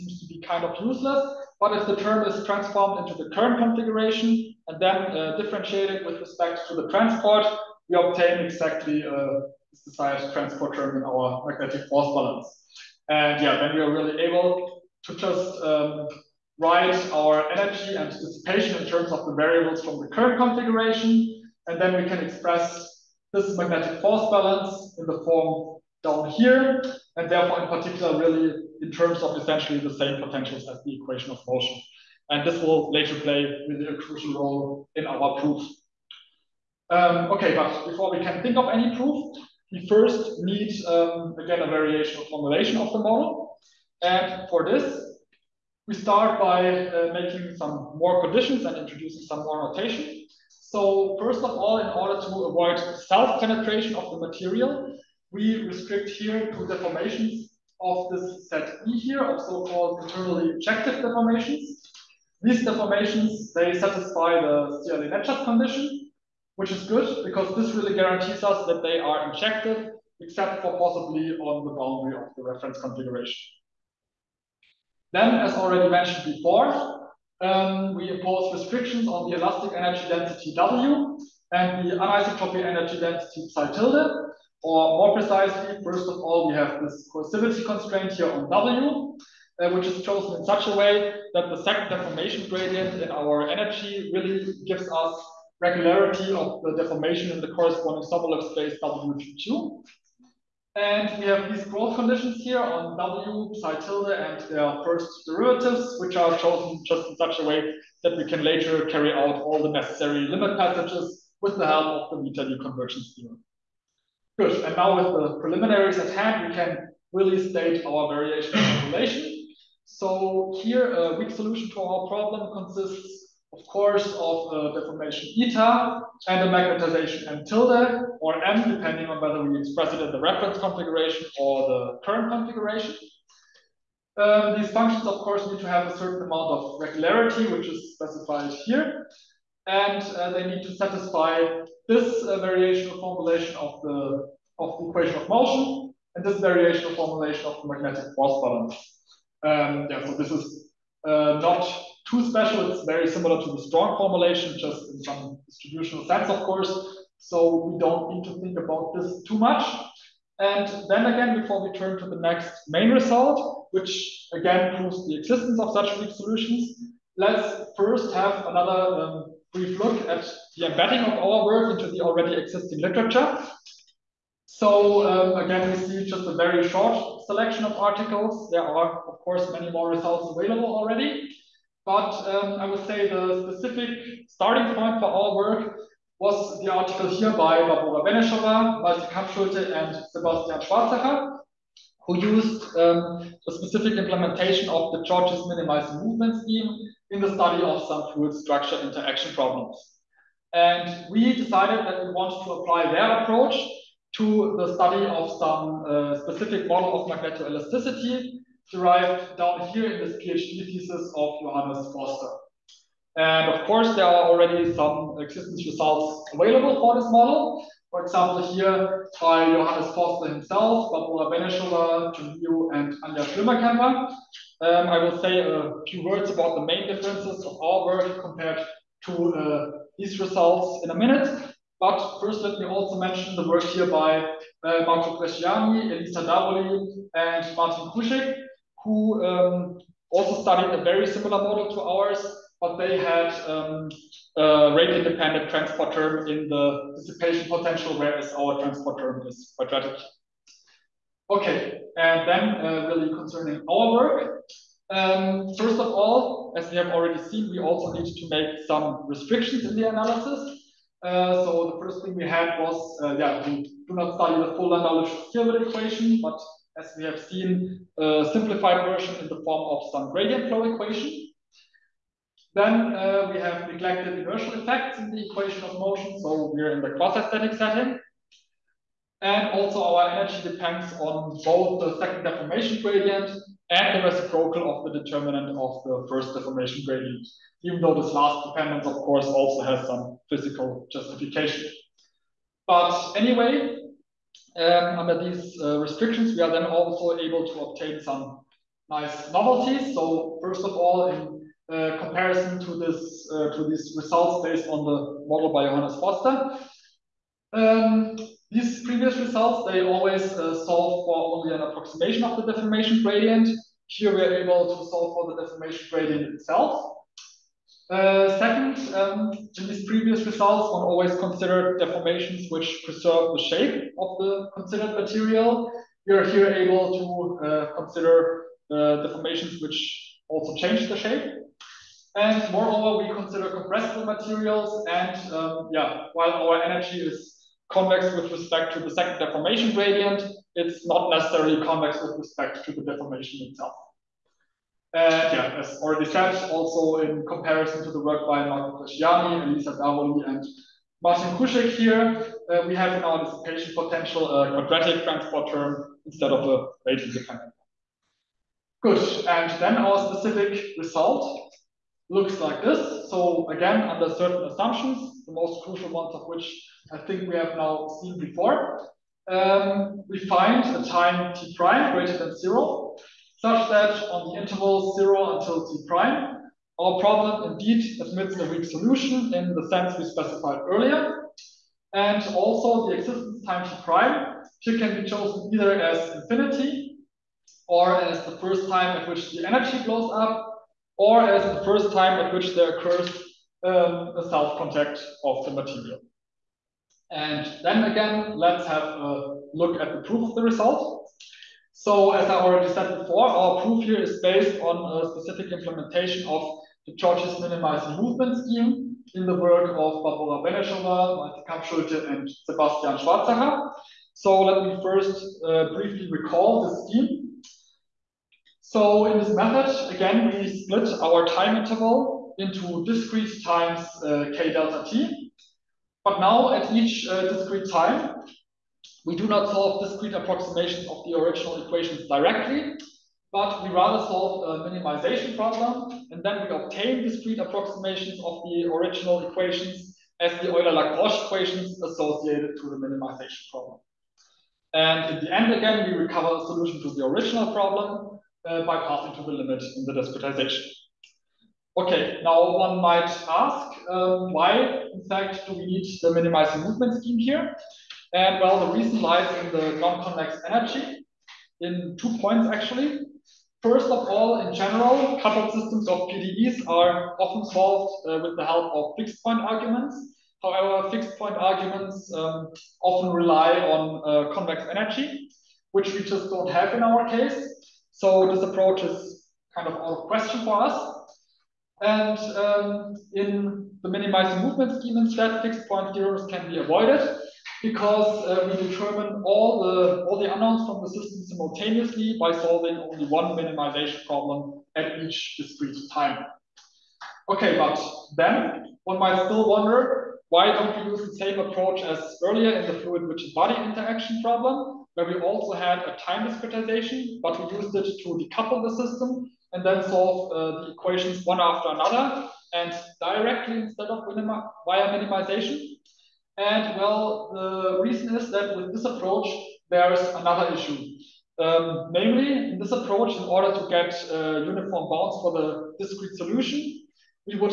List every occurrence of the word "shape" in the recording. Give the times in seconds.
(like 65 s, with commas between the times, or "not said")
323 s, 330 s.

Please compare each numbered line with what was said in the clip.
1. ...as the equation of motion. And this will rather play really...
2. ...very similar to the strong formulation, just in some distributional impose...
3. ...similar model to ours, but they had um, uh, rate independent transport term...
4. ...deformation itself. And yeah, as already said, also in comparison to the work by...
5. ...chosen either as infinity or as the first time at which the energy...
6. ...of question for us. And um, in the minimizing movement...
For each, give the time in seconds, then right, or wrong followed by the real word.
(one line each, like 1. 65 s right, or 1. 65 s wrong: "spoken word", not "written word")
1. 30 s wrong: "later", not "rather"
2. 152 s wrong: "sense", not "impose"
3. 241 s right
4. 342 s right
5. 385 s right
6. 480 s right.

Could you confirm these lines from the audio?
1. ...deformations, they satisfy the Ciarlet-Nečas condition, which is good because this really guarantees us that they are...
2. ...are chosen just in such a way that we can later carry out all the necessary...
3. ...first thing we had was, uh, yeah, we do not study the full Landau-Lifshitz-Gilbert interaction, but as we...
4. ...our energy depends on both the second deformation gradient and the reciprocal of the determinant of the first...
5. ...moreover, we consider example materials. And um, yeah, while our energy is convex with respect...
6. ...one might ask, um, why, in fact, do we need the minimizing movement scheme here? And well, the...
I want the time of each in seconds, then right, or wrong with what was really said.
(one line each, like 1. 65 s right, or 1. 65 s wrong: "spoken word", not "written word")
1. 62 s right
2. 106 s right
3. 261 s wrong: "equation", not "interaction"
4. 279 s right
5. 332 s wrong: "compressible", not "example"
6. 452 s right.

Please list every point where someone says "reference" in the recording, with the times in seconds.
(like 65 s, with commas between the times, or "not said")
72 s, 130 s.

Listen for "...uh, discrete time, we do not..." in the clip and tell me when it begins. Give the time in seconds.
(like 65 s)
427 s.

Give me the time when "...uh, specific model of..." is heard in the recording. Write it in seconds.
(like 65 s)
205 s.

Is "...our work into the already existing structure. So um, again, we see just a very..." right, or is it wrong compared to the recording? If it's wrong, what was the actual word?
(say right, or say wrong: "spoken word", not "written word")
wrong: "literature", not "structure".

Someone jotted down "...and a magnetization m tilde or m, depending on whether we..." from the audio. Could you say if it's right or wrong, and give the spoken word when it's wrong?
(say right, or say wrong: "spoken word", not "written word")
right.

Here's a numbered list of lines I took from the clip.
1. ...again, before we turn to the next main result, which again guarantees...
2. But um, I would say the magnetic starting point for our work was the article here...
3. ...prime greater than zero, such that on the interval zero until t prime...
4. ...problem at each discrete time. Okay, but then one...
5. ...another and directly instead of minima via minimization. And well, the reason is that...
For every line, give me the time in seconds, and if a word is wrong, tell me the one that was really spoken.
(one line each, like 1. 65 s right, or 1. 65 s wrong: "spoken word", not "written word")
1. 161 s wrong: "proves", not "guarantees"
2. 181 s wrong: "specific", not "magnetic"
3. 371 s right
4. 494 s right
5. 511 s right.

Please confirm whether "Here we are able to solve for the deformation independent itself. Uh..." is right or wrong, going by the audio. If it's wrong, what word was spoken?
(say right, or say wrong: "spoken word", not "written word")
wrong: "gradient", not "independent".